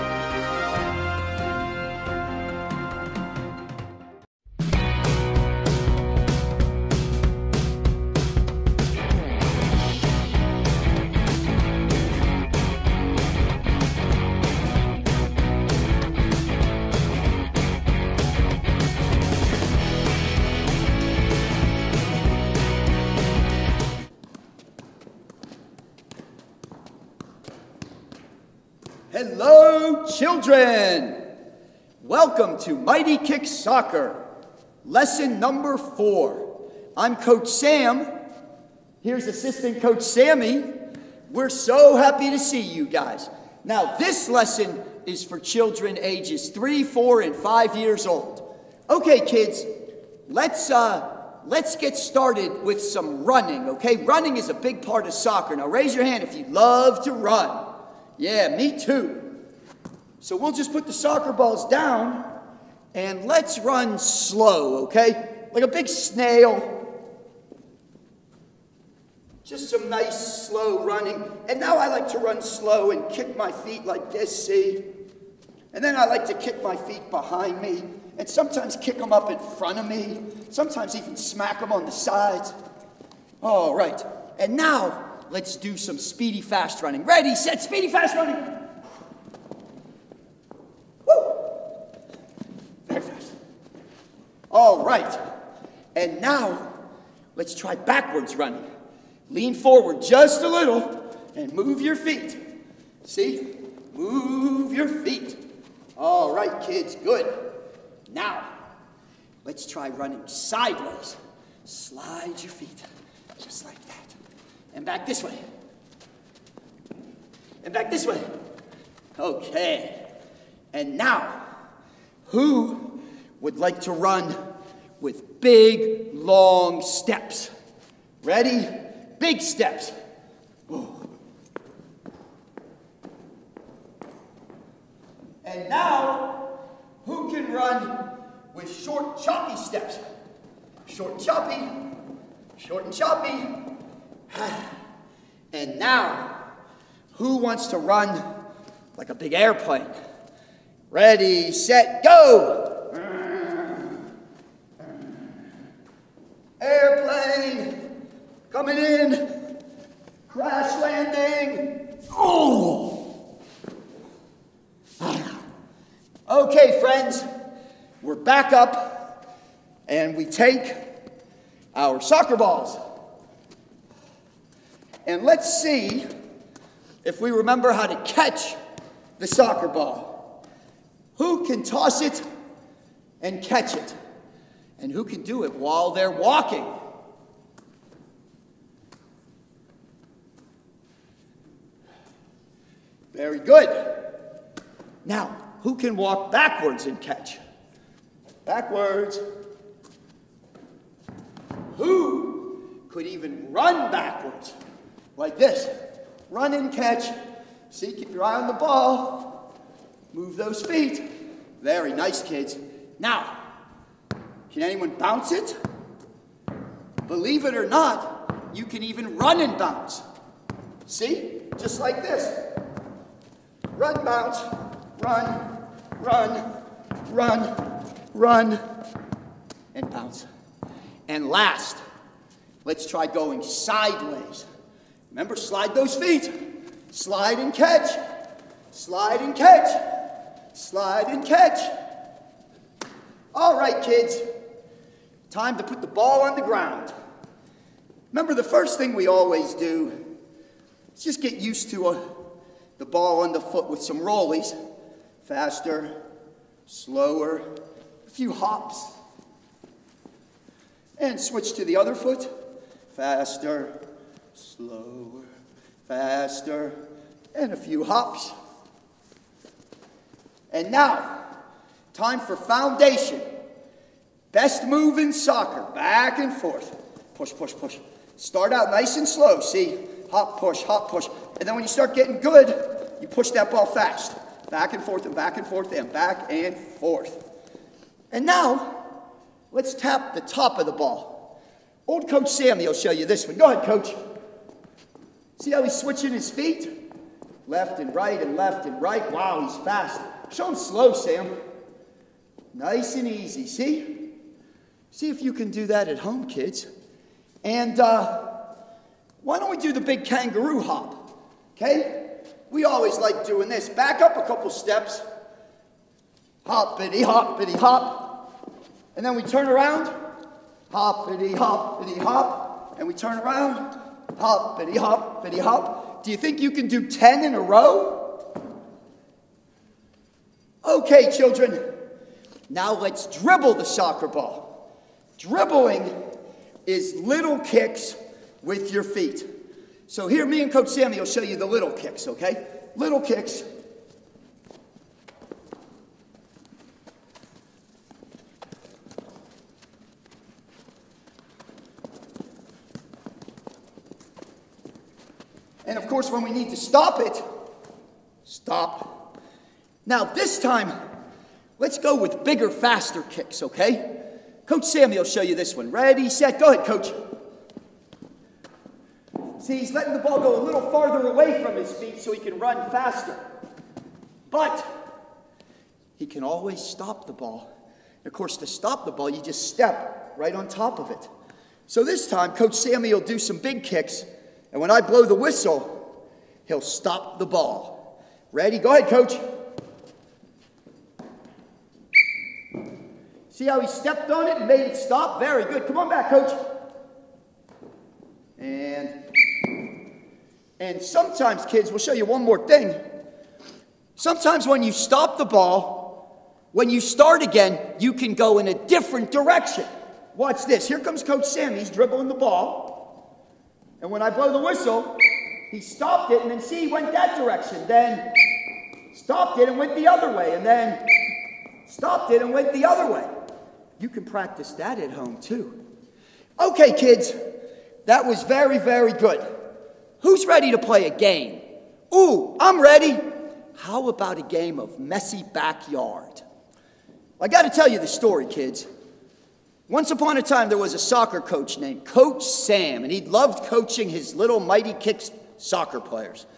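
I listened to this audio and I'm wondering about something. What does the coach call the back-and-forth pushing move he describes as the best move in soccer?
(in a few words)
Foundation.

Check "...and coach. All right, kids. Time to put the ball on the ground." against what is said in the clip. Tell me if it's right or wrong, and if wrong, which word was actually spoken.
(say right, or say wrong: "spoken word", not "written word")
wrong: "catch", not "coach".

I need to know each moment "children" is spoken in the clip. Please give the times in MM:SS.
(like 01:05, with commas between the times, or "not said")
00:30, 00:45, 05:31.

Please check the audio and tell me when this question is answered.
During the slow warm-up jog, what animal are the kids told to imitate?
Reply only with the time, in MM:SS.
01:05.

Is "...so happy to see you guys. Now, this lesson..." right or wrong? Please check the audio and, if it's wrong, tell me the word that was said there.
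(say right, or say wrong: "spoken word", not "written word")
right.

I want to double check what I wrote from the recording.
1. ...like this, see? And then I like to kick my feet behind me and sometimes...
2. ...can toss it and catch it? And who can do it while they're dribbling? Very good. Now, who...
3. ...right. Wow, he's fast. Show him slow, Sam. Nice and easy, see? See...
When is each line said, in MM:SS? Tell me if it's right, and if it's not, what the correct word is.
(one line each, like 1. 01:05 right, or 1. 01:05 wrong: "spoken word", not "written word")
1. 01:13 right
2. 03:01 wrong: "walking", not "dribbling"
3. 04:58 right.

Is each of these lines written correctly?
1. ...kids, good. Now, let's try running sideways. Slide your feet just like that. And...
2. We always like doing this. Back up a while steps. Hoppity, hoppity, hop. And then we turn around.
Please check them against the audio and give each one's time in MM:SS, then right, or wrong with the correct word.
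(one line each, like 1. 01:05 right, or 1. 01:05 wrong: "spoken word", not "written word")
1. 01:46 right
2. 05:12 wrong: "couple", not "while".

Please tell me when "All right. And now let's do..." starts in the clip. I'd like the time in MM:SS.
01:23.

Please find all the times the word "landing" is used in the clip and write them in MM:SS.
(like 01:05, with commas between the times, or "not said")
02:40.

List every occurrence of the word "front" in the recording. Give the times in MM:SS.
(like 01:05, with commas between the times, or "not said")
01:19.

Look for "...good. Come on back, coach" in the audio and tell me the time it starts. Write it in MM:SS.
06:35.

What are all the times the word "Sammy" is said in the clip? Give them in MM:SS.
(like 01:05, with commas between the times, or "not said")
00:40, 04:52, 05:40, 06:04, 06:22, 06:51.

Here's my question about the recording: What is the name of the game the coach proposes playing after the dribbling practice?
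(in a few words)
Messy backyard.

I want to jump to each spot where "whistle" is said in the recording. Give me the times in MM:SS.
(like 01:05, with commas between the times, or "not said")
06:25, 06:54.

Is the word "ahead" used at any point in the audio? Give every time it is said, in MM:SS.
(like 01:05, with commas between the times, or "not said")
04:53, 06:06, 06:28.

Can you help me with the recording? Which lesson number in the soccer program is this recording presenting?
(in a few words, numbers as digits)
4.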